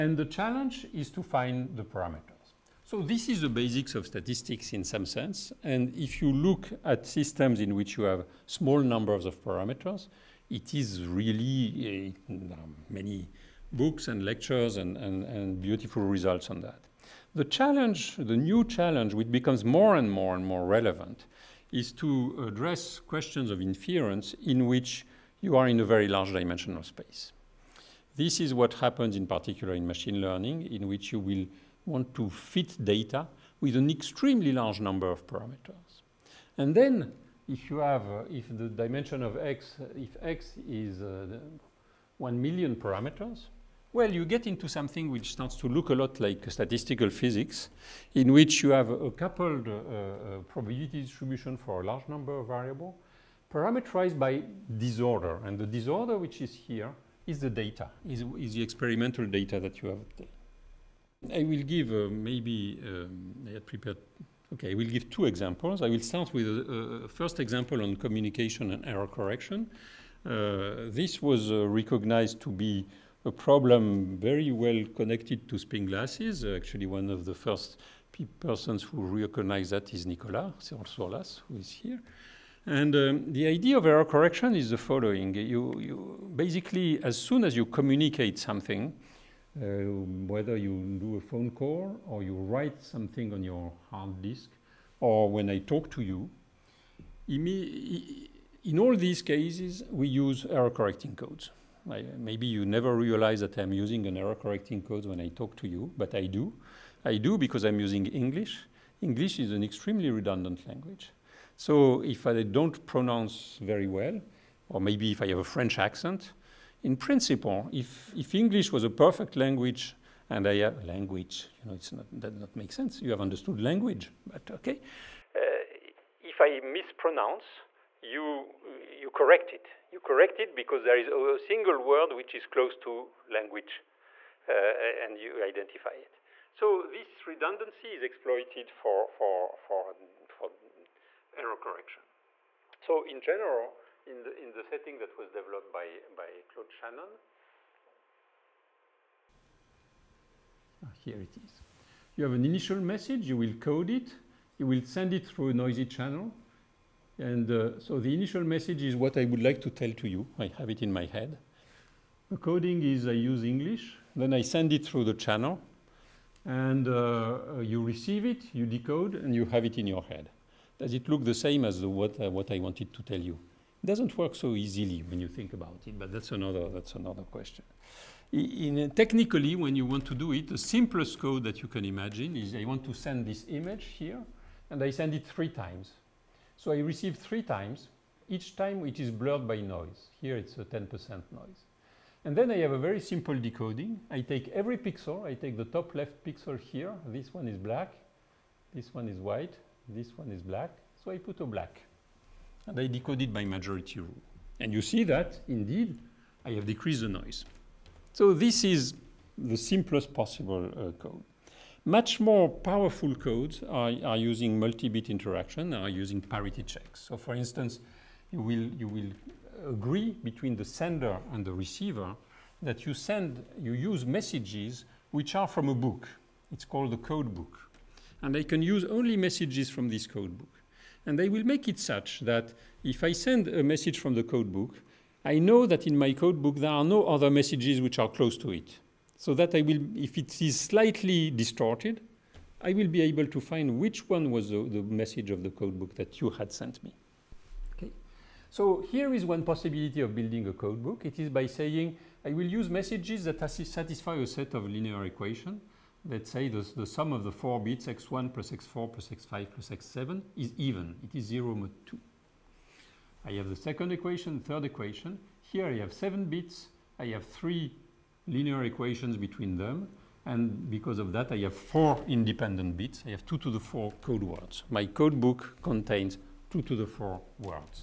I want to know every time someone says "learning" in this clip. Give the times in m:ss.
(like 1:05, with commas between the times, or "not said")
0:30.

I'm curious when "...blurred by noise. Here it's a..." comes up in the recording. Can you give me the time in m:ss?
3:09.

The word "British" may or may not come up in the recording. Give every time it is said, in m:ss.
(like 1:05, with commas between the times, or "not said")
not said.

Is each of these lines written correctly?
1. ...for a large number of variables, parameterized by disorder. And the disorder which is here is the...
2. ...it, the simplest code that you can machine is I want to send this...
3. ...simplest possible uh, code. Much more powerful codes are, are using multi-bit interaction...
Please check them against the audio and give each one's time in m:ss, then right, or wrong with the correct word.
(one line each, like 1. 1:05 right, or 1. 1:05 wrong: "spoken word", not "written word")
1. 0:51 right
2. 3:00 wrong: "imagine", not "machine"
3. 3:29 right.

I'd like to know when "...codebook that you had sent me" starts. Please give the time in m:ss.
4:05.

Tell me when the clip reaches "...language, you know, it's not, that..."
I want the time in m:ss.
2:00.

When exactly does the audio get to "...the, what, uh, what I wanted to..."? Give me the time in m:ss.
2:51.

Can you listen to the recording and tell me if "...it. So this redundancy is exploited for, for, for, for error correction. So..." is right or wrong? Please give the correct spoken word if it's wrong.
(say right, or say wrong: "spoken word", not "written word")
right.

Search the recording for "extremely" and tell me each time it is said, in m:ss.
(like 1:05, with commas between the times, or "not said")
0:33, 1:49.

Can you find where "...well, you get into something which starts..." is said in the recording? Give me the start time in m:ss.
0:43.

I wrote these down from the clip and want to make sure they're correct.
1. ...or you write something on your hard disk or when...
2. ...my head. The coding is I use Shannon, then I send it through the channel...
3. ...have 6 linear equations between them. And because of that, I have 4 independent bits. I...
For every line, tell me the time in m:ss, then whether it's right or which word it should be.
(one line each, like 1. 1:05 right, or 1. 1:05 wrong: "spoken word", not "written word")
1. 1:32 right
2. 2:40 wrong: "English", not "Shannon"
3. 4:27 wrong: "3", not "6".